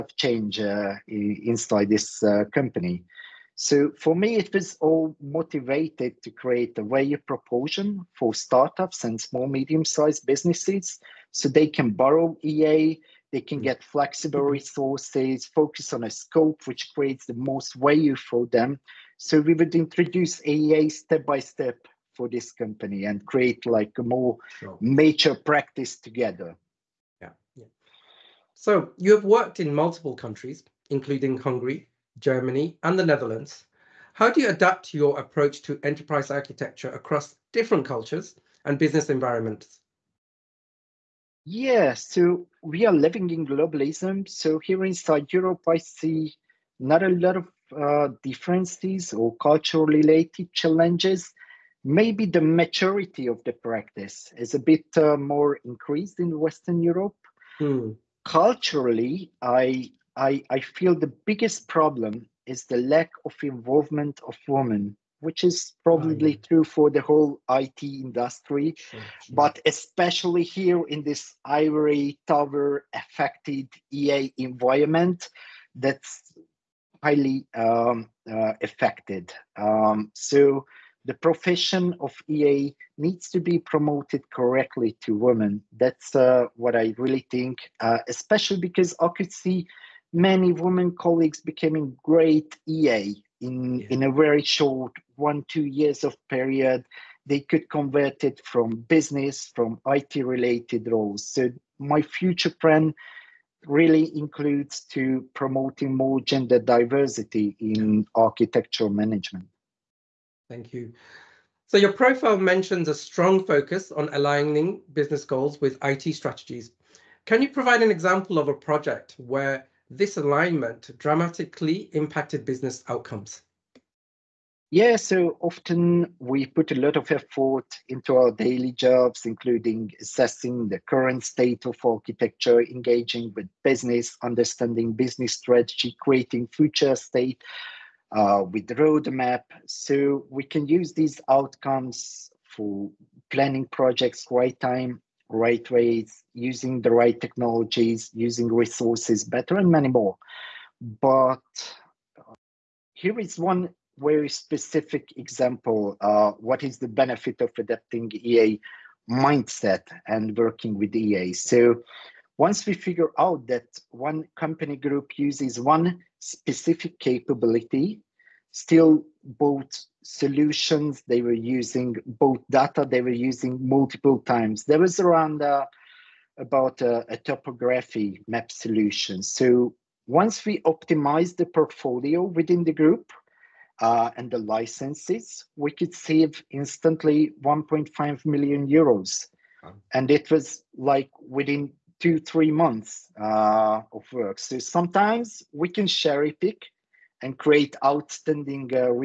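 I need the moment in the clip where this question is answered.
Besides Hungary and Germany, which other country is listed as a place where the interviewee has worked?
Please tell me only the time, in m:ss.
0:32.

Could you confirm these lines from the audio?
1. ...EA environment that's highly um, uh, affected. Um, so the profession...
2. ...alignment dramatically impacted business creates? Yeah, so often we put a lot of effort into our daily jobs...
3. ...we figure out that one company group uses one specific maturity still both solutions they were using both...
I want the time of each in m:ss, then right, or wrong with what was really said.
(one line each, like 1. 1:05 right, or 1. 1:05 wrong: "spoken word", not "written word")
1. 1:13 right
2. 2:00 wrong: "outcomes", not "creates"
3. 2:42 wrong: "capability", not "maturity".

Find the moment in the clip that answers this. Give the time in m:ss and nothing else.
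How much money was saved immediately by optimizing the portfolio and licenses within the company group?
3:07.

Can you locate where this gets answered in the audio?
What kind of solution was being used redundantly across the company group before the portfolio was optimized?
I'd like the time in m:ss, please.
2:57.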